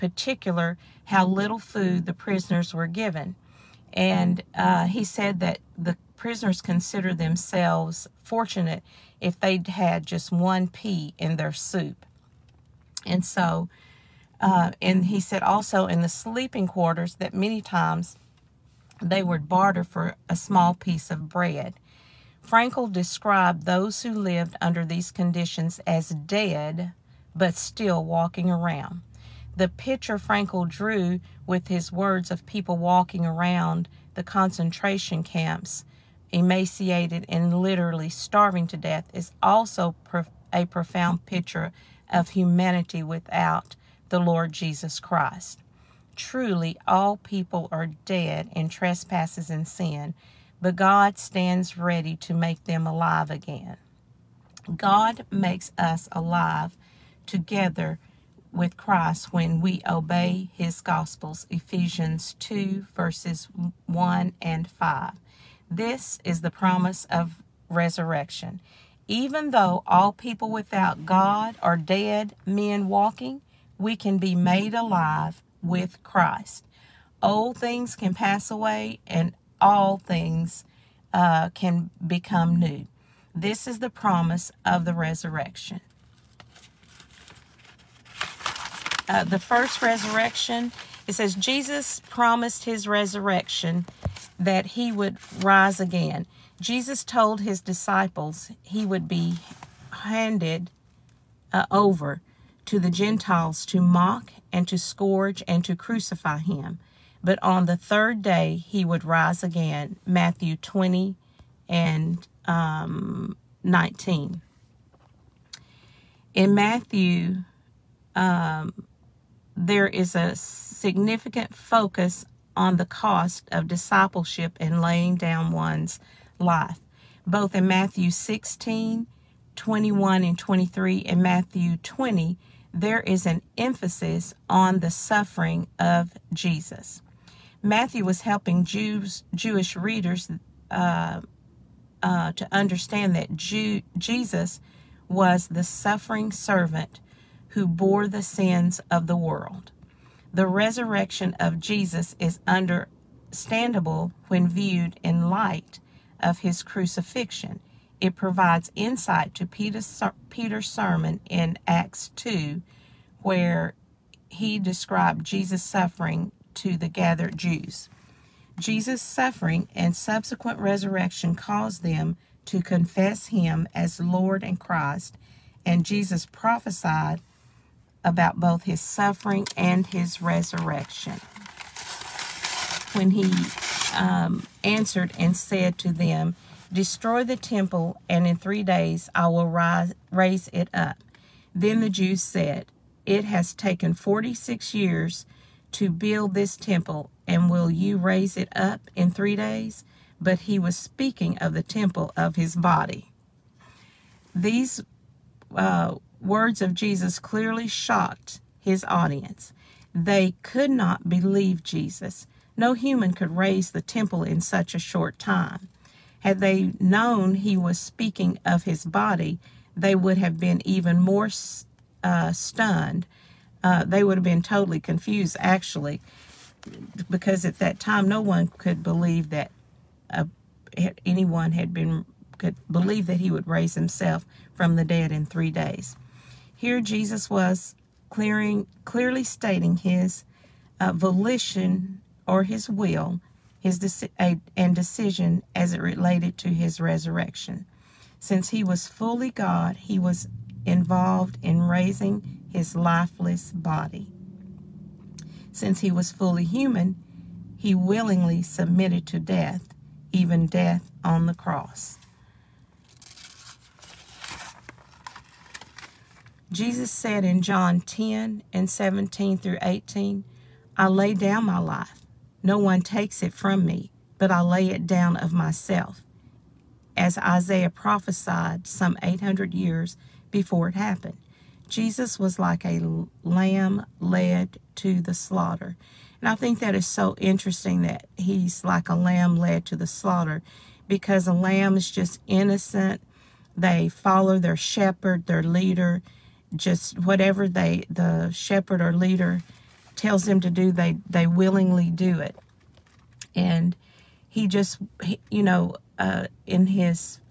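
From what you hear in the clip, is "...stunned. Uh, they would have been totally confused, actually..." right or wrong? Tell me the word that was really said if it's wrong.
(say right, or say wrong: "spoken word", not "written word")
right.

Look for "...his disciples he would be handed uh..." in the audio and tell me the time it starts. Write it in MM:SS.
01:37.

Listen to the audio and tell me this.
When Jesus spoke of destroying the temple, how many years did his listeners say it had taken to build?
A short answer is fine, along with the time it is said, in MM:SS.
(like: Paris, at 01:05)
46, at 03:13.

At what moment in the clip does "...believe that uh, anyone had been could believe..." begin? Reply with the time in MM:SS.
03:48.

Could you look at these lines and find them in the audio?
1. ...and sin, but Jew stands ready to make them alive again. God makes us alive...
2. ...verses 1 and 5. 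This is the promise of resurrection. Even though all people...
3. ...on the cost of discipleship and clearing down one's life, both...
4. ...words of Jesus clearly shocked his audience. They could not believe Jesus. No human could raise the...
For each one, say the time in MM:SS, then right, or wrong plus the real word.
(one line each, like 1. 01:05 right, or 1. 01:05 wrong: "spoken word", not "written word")
1. 00:49 wrong: "God", not "Jew"
2. 01:02 right
3. 02:02 wrong: "laying", not "clearing"
4. 03:26 right.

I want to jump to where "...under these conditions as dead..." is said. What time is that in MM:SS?
00:24.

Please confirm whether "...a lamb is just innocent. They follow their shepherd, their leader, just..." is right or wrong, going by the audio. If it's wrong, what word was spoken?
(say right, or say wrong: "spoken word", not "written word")
right.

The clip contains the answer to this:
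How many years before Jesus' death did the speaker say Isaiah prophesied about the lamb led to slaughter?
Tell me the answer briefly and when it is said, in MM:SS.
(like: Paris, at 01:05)
800, at 04:39.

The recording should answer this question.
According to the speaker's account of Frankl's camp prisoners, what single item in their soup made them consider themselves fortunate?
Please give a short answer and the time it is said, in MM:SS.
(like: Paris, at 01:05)
one pea, at 00:10.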